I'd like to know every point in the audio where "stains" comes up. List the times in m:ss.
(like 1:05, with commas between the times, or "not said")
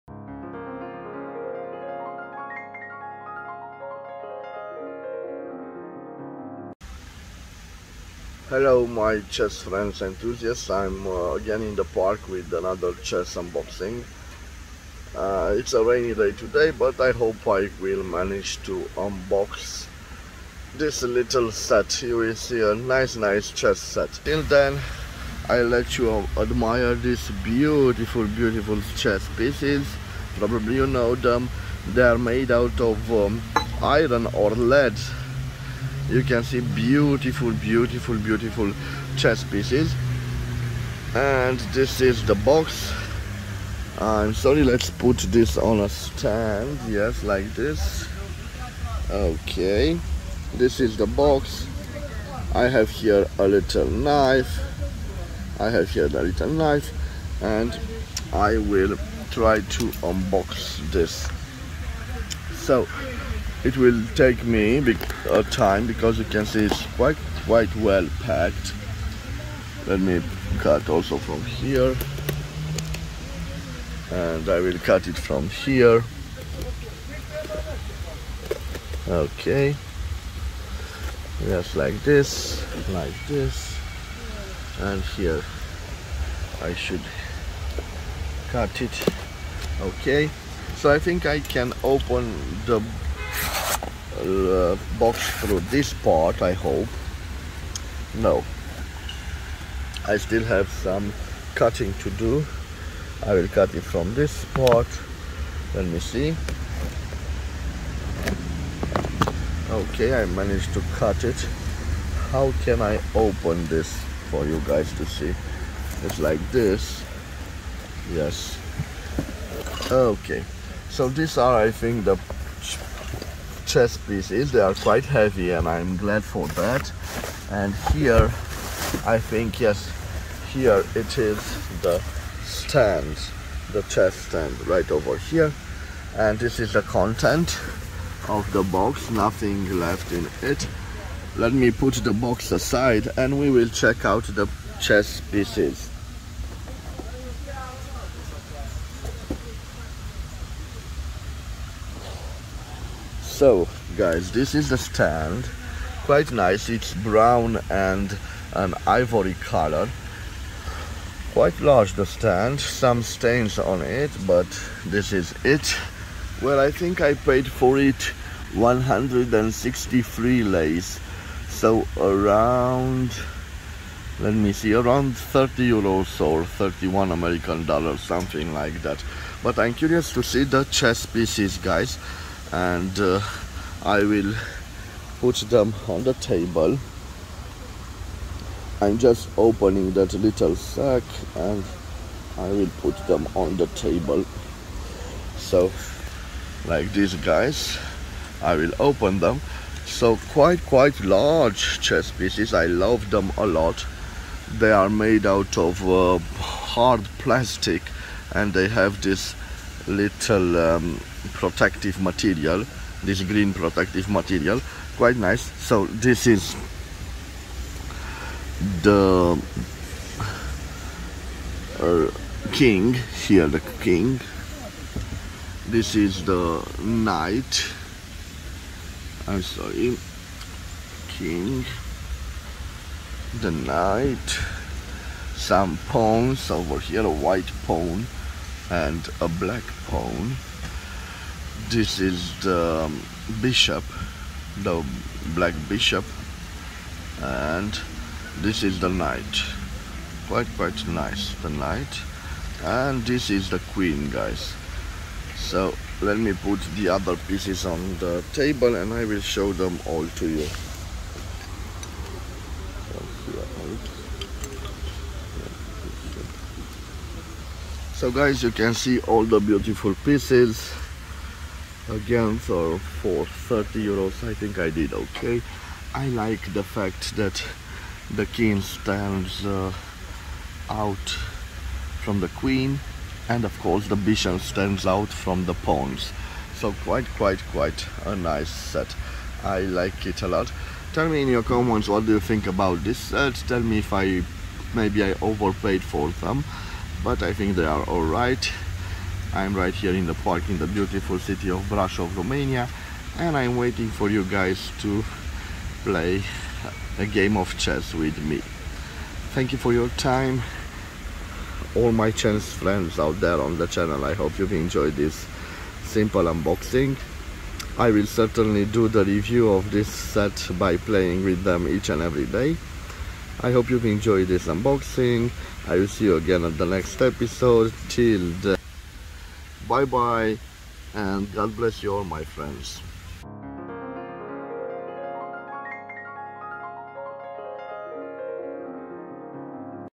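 2:43.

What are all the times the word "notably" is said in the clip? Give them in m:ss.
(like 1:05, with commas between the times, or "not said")
not said.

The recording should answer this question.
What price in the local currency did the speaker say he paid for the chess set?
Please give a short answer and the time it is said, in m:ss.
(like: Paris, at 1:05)
163 lei, at 2:48.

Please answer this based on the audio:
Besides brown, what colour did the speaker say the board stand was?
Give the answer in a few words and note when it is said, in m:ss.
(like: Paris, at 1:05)
Ivory, at 2:38.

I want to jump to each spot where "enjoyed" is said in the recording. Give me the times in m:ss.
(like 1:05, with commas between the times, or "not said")
5:14, 5:23.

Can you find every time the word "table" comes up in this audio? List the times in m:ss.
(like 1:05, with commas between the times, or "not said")
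3:06, 3:13, 4:18.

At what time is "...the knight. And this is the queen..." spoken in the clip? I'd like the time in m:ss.
4:11.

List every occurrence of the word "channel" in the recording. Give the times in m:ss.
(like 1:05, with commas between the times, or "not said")
5:13.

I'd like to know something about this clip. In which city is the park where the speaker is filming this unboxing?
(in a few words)
Brasov.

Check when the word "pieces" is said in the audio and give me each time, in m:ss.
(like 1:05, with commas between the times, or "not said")
0:29, 0:39, 2:04, 2:25, 3:01, 3:22, 4:17, 4:30.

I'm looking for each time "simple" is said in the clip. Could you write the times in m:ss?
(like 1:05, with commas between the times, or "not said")
5:15.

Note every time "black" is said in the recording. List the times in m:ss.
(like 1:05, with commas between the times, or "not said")
3:59, 4:05.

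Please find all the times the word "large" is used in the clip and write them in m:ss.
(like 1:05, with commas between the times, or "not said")
2:41, 3:21.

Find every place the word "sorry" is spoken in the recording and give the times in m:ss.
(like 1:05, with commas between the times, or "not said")
0:44, 3:49.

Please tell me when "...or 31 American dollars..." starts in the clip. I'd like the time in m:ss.
2:56.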